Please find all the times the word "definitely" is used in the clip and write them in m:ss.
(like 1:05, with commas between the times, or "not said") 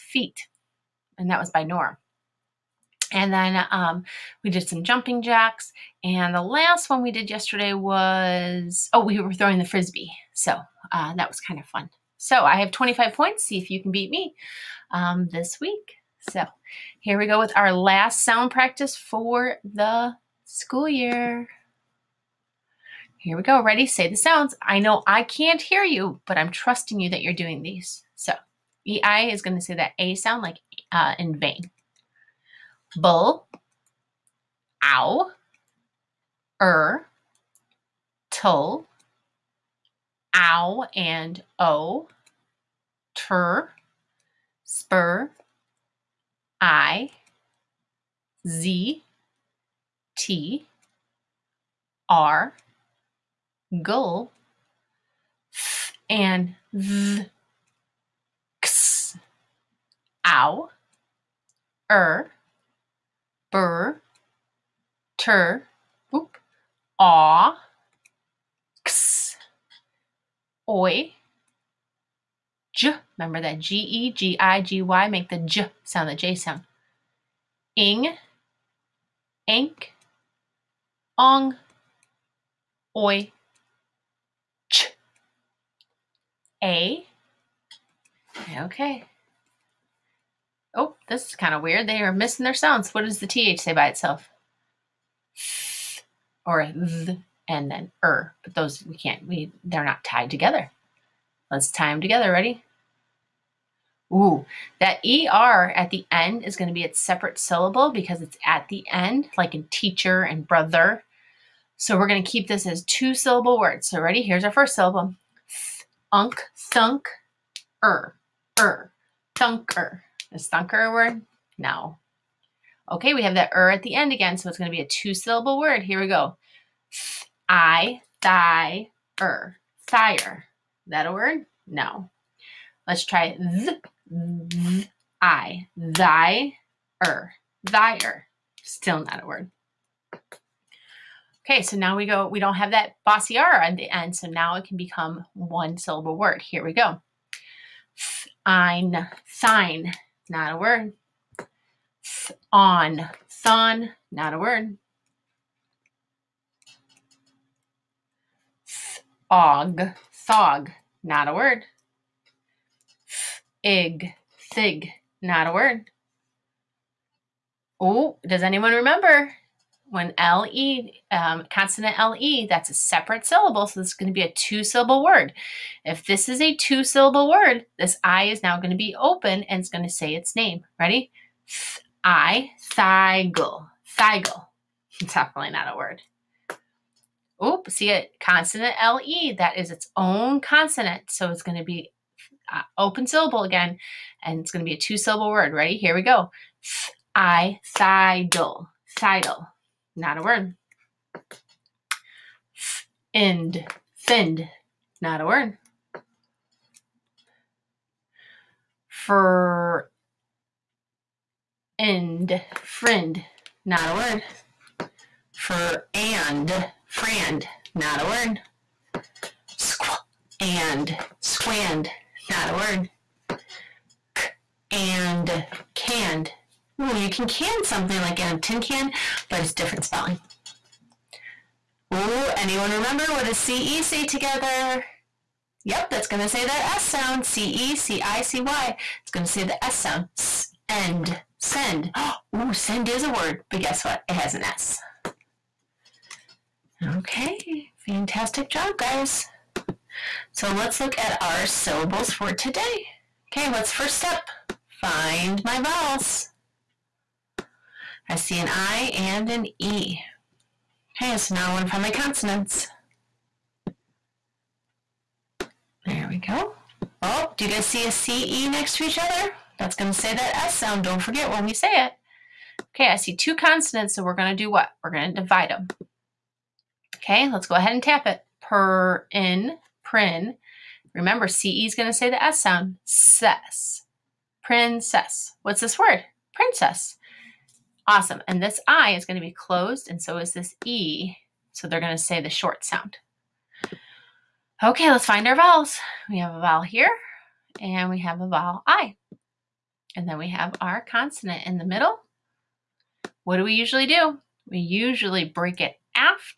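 3:05.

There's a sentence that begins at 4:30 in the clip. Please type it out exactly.
Don't forget when we say it.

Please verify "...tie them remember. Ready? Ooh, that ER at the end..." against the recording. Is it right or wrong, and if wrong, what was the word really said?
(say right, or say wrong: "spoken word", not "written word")
wrong: "together", not "remember".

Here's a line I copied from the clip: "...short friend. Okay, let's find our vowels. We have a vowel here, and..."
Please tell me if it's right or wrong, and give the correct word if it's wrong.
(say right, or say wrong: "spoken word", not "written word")
wrong: "sound", not "friend".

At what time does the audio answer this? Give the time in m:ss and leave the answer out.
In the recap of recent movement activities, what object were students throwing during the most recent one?
0:09.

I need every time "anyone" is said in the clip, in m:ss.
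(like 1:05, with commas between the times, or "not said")
2:48, 3:52.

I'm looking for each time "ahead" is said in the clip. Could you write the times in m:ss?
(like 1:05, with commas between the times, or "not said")
4:37.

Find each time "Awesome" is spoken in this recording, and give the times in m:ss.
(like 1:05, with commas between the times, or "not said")
4:47.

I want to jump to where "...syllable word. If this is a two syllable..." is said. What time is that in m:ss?
2:54.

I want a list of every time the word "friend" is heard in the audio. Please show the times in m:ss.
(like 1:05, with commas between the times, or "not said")
3:32, 3:36.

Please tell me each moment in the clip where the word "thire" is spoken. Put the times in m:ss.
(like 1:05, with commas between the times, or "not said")
2:09, 2:17.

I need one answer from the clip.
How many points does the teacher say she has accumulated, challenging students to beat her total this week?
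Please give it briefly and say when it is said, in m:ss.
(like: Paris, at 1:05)
25, at 0:12.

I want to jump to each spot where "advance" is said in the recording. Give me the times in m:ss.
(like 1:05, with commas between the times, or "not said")
not said.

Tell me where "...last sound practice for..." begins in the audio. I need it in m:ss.
0:17.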